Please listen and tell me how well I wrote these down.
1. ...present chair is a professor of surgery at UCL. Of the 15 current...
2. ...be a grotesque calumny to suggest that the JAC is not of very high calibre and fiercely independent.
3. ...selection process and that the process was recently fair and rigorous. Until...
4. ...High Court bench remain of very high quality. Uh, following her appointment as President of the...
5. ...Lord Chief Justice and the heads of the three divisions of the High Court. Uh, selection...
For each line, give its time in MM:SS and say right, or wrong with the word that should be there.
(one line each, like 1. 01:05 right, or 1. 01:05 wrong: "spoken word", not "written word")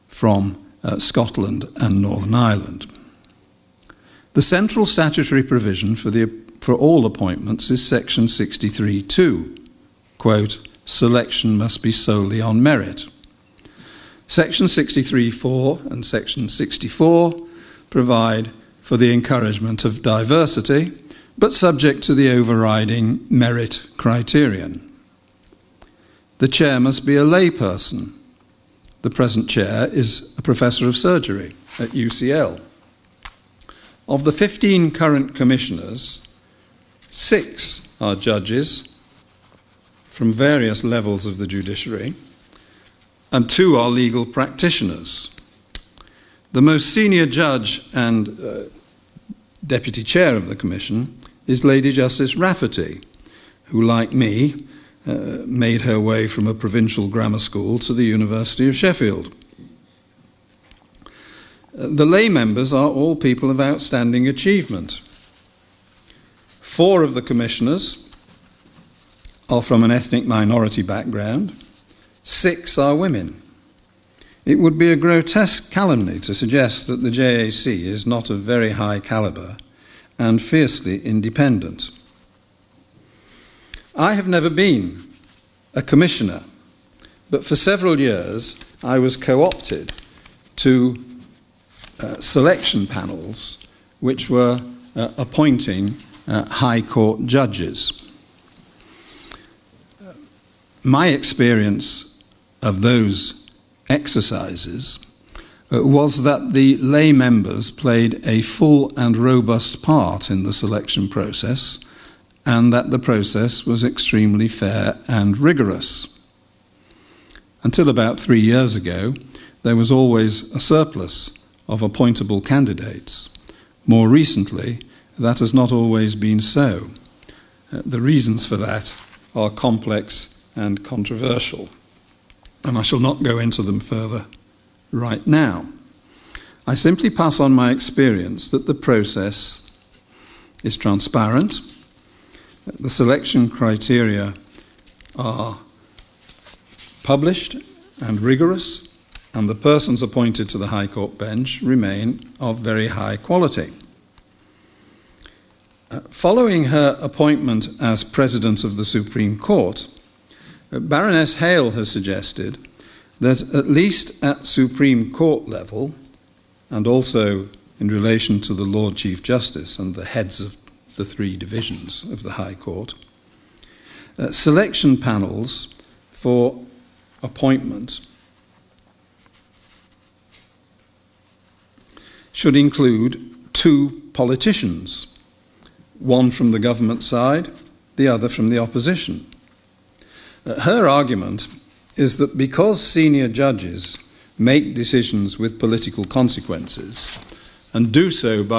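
1. 00:29 right
2. 01:14 right
3. 01:50 wrong: "extremely", not "recently"
4. 02:30 right
5. 02:48 right.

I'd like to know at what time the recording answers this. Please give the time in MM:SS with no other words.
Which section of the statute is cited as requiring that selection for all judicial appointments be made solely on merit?
00:07.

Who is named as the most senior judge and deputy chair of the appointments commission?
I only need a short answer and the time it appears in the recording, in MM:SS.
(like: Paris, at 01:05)
Lady Justice Rafferty, at 00:51.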